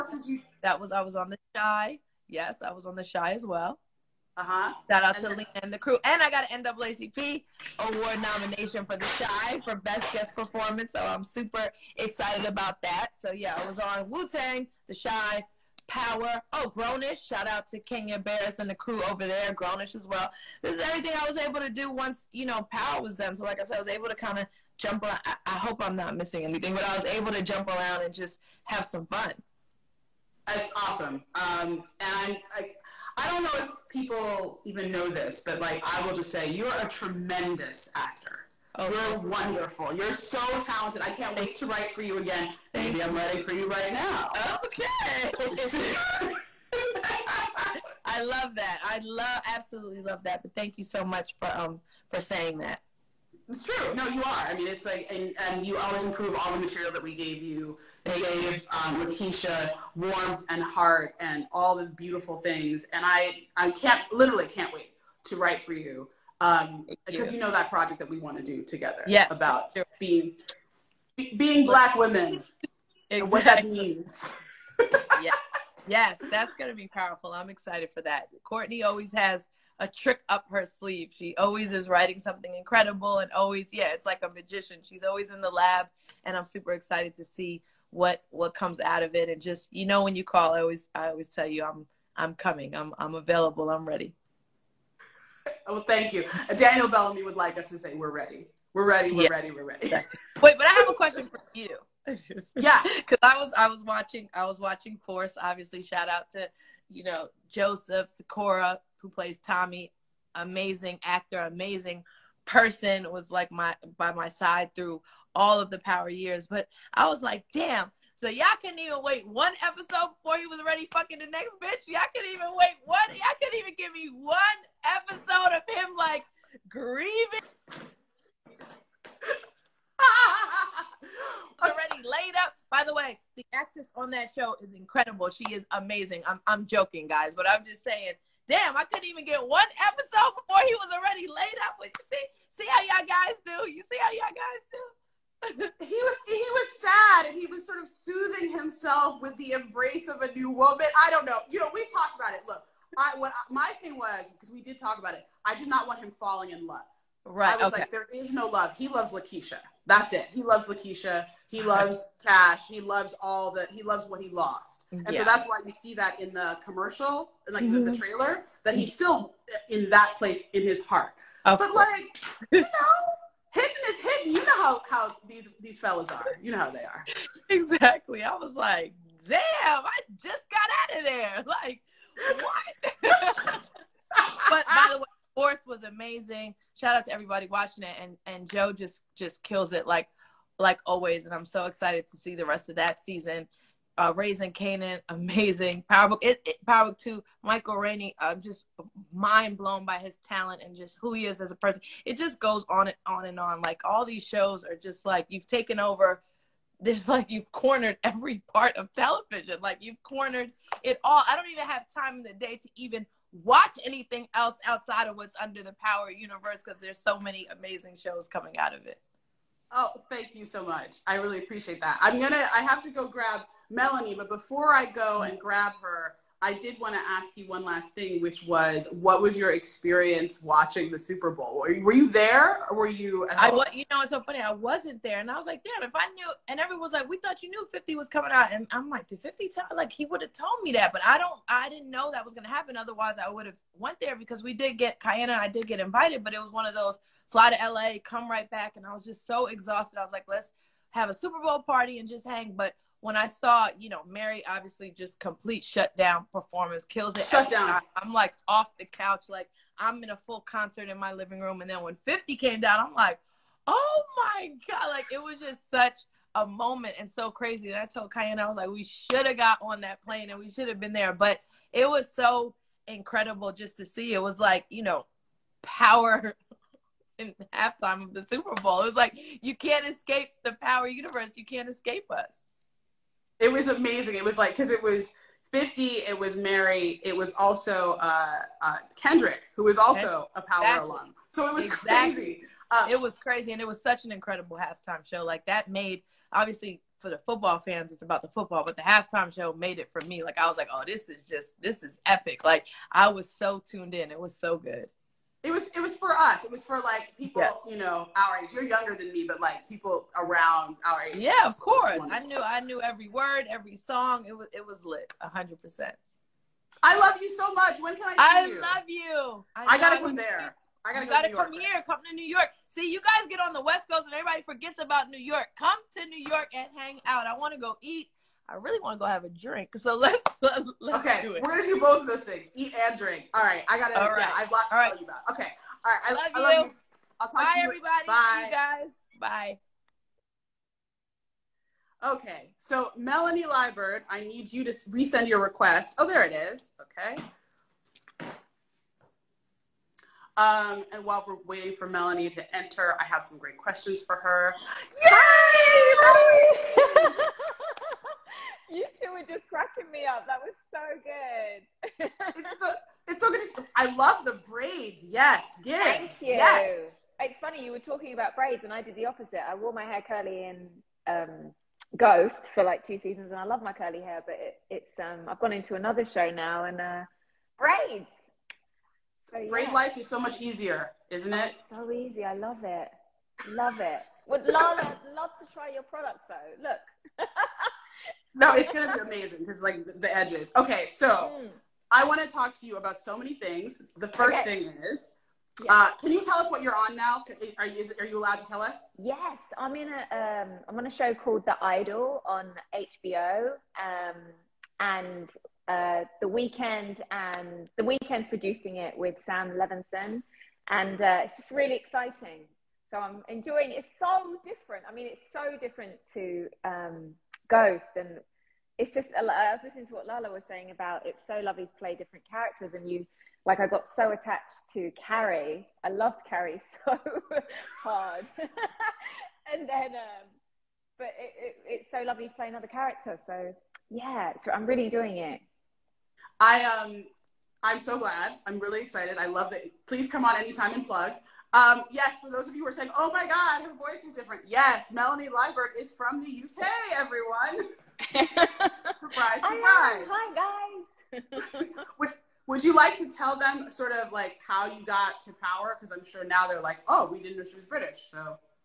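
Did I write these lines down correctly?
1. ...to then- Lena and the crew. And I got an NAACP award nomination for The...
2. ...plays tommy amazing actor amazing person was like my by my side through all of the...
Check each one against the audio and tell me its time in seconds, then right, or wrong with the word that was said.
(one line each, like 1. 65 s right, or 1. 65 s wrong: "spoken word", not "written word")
1. 5 s right
2. 109 s right.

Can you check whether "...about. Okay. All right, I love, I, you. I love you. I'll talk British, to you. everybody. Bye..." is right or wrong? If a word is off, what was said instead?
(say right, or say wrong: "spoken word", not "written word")
wrong: "Bye", not "British".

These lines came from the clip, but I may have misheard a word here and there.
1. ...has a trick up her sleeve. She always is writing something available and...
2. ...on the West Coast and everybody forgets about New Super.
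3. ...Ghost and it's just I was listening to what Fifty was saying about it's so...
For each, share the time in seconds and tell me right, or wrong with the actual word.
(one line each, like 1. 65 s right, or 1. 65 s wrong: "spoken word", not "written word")
1. 79 s wrong: "incredible", not "available"
2. 323 s wrong: "York", not "Super"
3. 417 s wrong: "Lala", not "Fifty".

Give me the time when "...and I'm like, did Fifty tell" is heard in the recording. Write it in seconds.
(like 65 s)
238 s.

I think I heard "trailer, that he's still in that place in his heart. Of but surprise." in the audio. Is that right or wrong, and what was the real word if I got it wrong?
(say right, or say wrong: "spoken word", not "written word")
wrong: "course", not "surprise".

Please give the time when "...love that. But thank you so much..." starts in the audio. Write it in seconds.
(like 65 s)
49 s.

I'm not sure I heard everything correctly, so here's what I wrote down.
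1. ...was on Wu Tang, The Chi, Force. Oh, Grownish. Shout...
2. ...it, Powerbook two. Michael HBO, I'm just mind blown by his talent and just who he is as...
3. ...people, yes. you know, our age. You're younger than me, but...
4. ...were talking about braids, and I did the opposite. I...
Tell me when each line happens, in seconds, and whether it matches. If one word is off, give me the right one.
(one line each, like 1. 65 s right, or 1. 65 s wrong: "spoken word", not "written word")
1. 13 s wrong: "Power", not "Force"
2. 196 s wrong: "Rainey", not "HBO"
3. 307 s right
4. 367 s right.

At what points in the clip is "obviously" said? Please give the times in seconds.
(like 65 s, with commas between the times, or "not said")
105 s, 254 s, 296 s.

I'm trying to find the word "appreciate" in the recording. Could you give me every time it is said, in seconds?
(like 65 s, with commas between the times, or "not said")
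221 s.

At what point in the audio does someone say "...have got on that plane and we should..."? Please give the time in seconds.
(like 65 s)
269 s.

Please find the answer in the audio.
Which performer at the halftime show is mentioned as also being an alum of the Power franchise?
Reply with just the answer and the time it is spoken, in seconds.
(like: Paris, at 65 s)
Kendrick, at 288 s.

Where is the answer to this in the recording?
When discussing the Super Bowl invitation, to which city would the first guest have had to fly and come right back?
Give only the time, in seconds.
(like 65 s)
247 s.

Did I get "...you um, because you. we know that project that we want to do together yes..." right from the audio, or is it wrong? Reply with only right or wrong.
right.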